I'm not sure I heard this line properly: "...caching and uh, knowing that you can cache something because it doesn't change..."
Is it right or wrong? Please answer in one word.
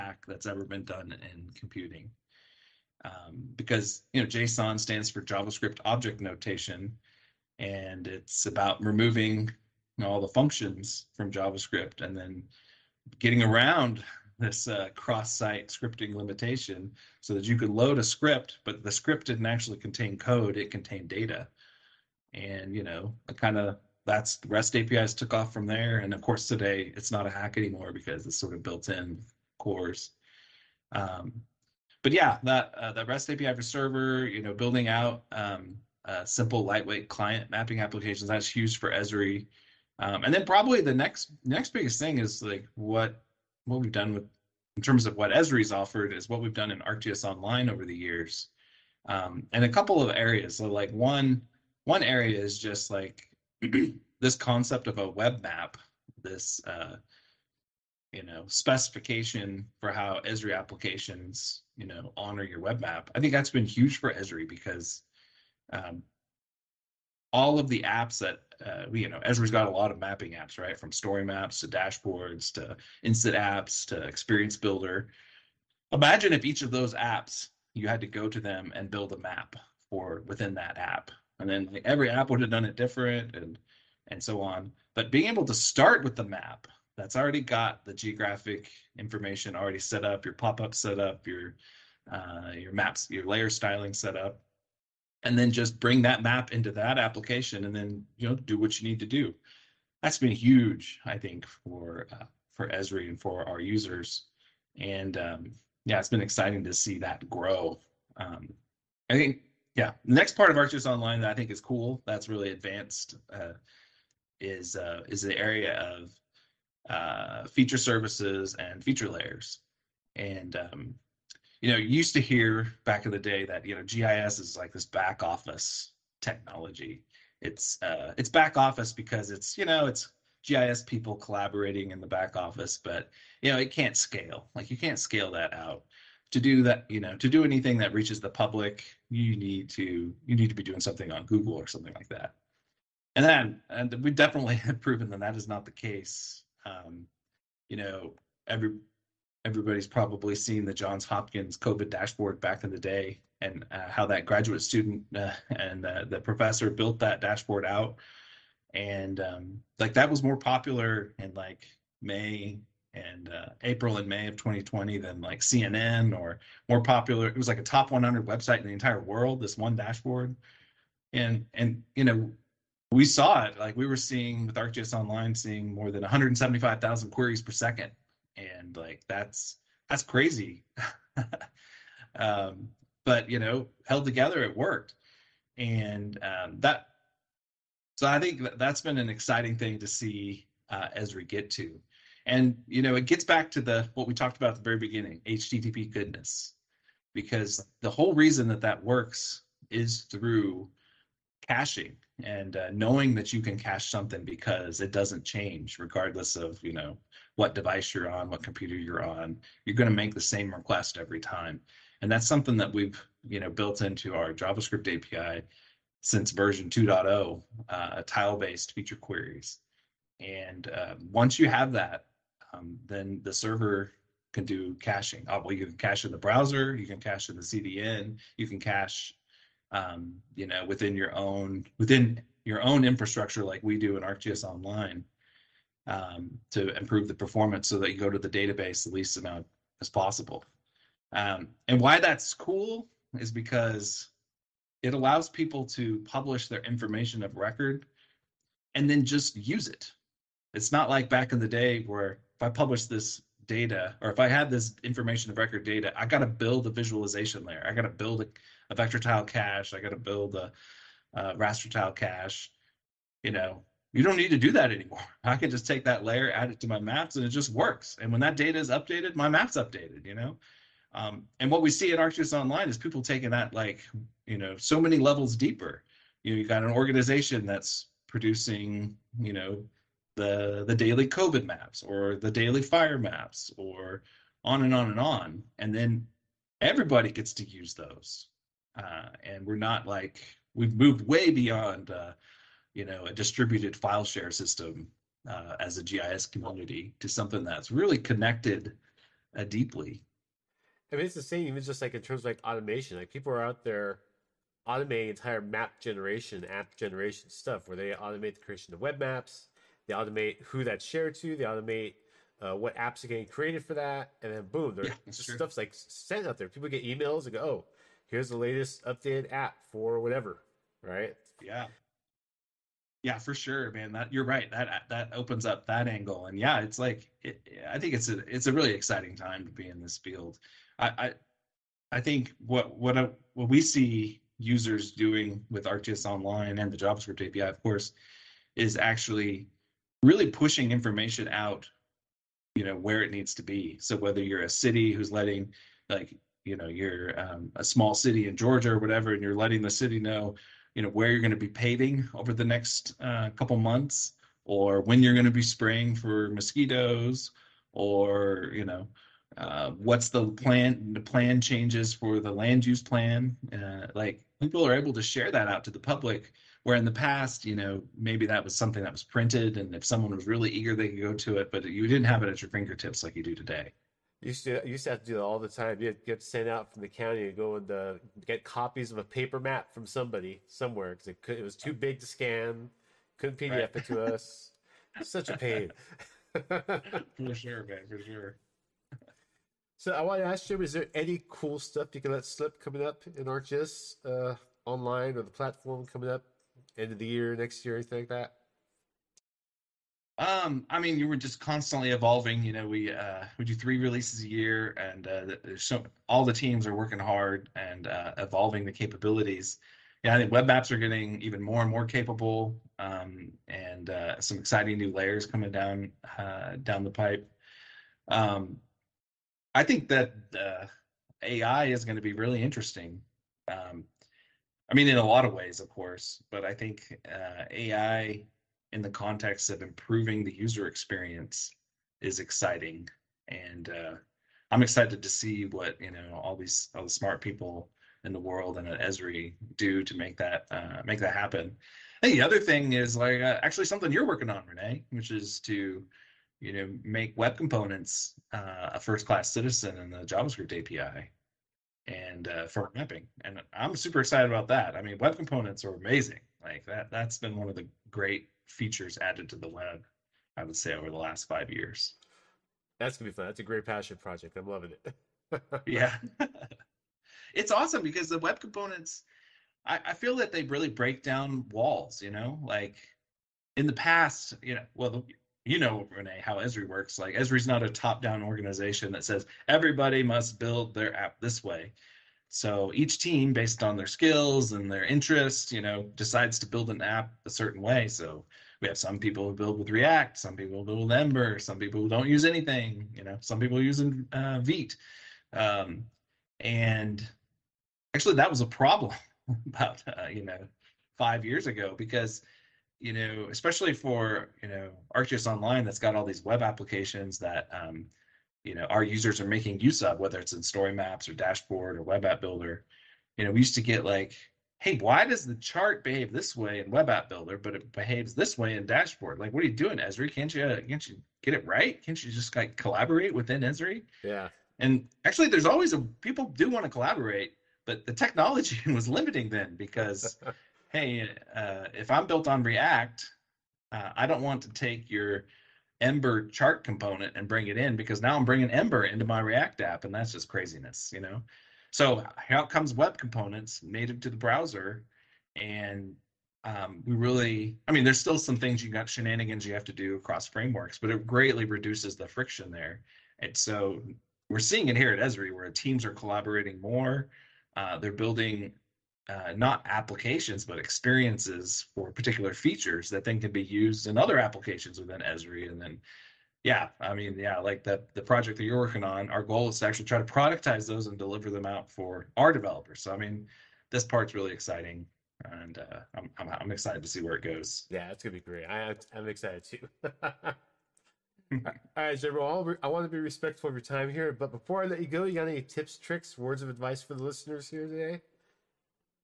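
right.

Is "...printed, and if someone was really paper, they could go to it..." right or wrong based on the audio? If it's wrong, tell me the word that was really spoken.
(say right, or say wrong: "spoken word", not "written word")
wrong: "eager", not "paper".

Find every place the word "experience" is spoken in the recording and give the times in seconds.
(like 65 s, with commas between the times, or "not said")
74 s, 430 s, 560 s.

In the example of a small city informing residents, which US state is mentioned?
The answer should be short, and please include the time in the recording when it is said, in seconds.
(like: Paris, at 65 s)
Georgia, at 348 s.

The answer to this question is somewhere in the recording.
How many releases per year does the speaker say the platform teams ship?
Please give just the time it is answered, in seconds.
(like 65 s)
403 s.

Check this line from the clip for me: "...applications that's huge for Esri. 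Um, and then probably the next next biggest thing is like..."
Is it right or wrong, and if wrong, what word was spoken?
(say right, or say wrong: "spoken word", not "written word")
right.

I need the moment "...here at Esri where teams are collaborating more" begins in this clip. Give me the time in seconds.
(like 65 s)
554 s.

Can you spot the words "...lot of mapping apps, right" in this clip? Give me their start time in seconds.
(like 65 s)
69 s.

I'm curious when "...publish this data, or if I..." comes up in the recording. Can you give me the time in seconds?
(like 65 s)
252 s.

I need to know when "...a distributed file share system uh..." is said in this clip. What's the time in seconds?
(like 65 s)
293 s.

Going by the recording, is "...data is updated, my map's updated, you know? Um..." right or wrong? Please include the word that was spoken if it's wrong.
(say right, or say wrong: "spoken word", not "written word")
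right.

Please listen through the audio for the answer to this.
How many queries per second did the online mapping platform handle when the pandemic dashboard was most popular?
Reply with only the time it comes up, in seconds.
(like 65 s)
176 s.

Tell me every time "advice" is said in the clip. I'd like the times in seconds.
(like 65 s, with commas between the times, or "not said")
586 s.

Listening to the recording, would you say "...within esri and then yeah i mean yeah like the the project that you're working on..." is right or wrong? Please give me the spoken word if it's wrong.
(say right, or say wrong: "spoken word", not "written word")
right.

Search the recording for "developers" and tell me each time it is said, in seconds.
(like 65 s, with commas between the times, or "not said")
572 s.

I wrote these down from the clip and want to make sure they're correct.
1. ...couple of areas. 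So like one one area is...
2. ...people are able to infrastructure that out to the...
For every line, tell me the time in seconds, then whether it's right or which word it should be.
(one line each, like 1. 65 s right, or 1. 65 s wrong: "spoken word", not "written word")
1. 49 s right
2. 364 s wrong: "share", not "infrastructure".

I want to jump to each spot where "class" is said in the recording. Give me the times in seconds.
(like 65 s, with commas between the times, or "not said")
449 s.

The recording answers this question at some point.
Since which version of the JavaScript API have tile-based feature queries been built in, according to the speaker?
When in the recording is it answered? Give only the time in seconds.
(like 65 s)
216 s.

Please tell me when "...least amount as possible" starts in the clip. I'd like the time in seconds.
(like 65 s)
238 s.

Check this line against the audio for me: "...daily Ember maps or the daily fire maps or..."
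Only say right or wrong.
wrong.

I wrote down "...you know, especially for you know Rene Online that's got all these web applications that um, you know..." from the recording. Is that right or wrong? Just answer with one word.
wrong.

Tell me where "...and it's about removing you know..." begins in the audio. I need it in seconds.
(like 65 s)
7 s.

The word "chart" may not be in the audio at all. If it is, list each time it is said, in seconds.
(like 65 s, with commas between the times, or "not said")
515 s, 536 s.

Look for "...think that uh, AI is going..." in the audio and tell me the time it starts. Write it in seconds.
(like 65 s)
419 s.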